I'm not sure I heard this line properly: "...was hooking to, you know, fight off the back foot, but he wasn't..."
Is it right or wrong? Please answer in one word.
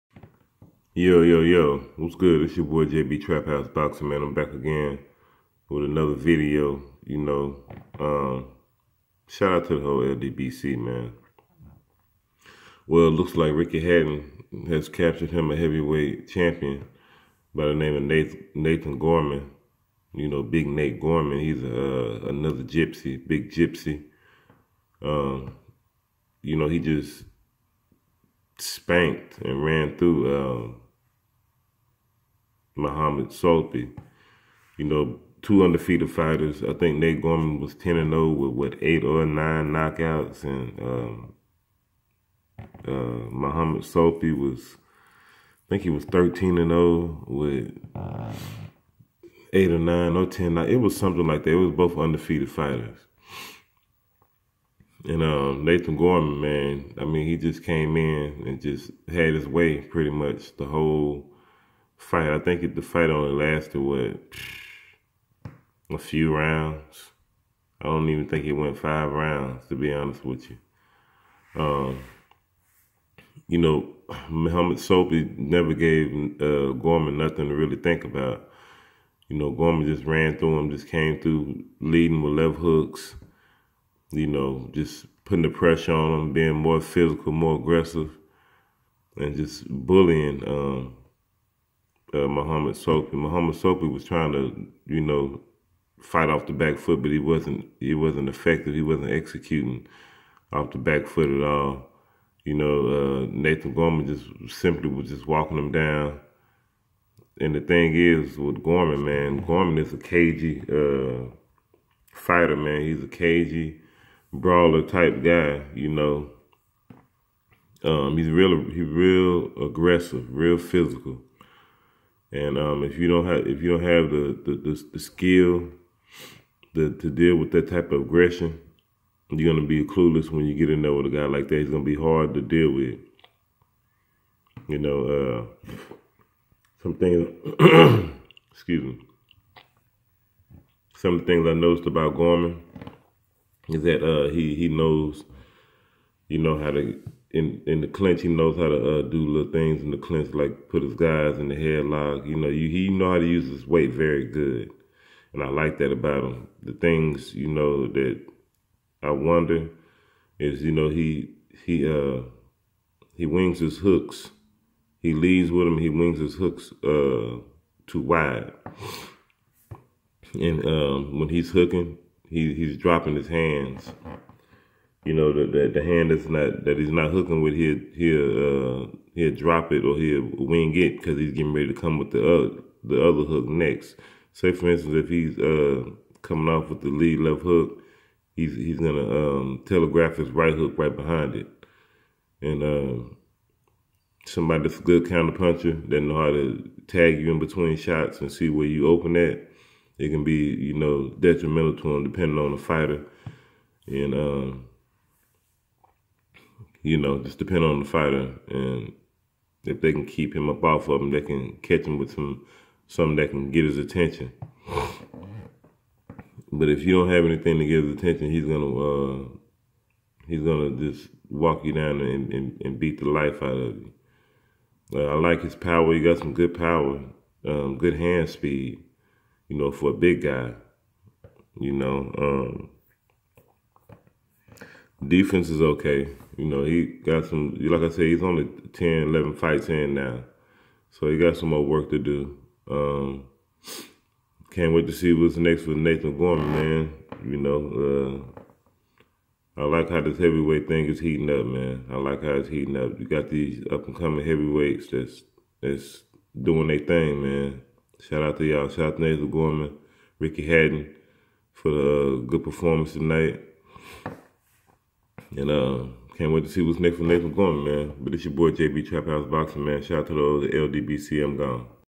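wrong.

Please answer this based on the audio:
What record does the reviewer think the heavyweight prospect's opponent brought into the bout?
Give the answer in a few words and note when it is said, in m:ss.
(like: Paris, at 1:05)
13 and 0, at 0:46.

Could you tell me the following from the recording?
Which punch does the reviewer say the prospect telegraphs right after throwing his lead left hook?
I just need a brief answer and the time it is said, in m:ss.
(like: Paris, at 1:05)
right hook, at 3:10.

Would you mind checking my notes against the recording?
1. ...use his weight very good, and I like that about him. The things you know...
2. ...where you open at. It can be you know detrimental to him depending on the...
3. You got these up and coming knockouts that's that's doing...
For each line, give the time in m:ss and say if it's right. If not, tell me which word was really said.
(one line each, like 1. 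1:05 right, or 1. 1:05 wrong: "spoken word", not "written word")
1. 2:33 right
2. 3:18 right
3. 4:12 wrong: "heavyweights", not "knockouts".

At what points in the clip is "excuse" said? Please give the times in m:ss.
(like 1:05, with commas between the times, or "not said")
2:18.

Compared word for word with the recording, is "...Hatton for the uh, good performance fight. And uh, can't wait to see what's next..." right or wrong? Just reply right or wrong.
wrong.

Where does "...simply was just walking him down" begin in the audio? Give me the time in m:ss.
1:44.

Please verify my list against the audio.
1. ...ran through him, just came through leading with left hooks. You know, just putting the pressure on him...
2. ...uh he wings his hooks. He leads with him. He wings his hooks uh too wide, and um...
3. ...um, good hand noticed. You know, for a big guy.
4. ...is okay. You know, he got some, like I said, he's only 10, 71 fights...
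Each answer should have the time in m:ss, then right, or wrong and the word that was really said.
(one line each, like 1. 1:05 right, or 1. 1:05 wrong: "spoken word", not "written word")
1. 1:20 right
2. 2:41 right
3. 3:47 wrong: "speed", not "noticed"
4. 3:55 wrong: "11", not "71".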